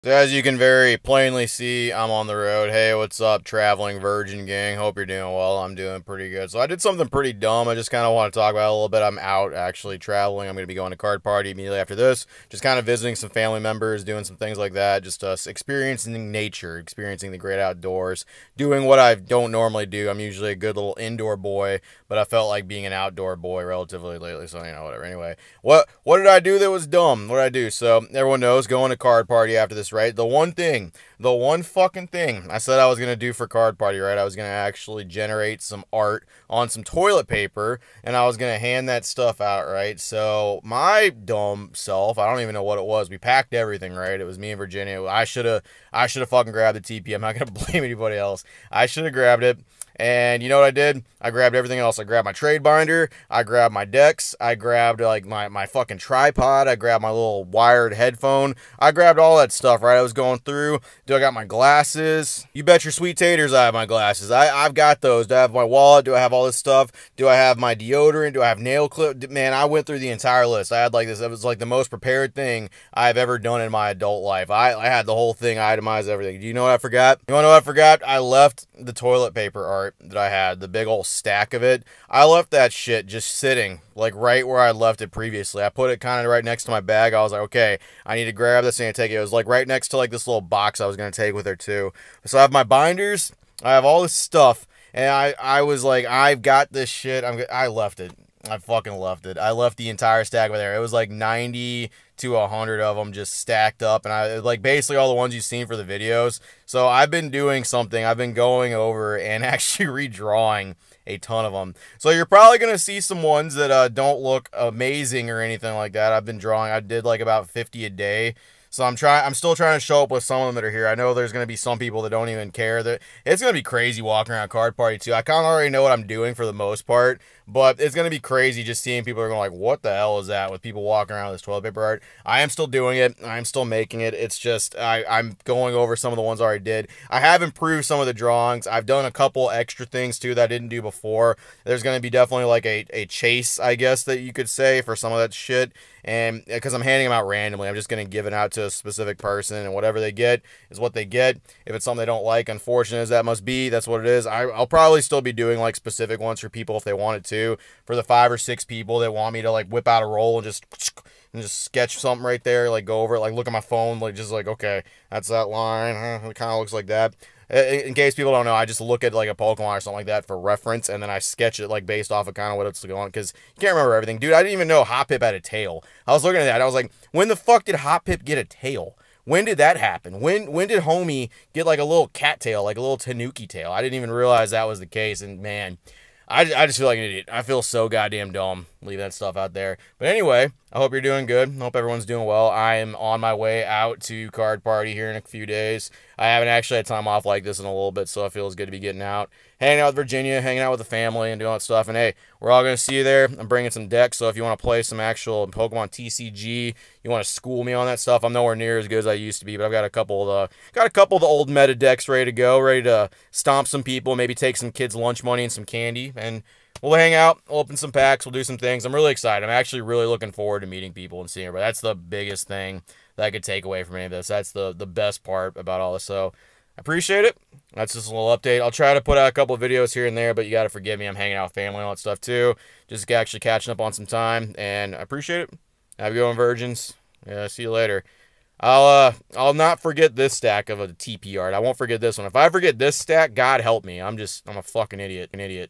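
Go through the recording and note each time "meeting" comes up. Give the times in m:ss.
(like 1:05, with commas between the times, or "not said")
3:40.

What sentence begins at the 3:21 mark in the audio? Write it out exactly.
And hey, we're all gonna see you there.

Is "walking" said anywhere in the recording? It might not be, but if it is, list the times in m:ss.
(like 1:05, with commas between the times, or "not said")
2:04, 2:10.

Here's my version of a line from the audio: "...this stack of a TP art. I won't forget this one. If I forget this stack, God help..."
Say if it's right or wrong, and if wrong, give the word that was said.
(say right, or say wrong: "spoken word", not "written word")
right.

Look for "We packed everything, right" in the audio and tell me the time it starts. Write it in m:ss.
0:43.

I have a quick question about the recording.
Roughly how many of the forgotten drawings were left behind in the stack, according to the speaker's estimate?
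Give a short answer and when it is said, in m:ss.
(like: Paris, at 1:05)
90 to 100, at 1:41.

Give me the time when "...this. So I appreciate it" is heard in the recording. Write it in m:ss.
3:45.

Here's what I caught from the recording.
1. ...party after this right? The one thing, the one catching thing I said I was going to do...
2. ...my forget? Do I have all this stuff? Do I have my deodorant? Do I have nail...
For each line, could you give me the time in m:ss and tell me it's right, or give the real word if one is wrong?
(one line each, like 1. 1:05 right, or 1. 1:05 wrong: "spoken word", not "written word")
1. 0:29 wrong: "fucking", not "catching"
2. 1:05 wrong: "wallet", not "forget".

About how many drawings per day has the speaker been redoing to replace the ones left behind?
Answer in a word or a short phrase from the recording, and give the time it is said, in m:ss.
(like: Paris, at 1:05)
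50, at 1:57.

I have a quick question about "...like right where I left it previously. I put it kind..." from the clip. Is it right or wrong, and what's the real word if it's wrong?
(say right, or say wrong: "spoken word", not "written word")
right.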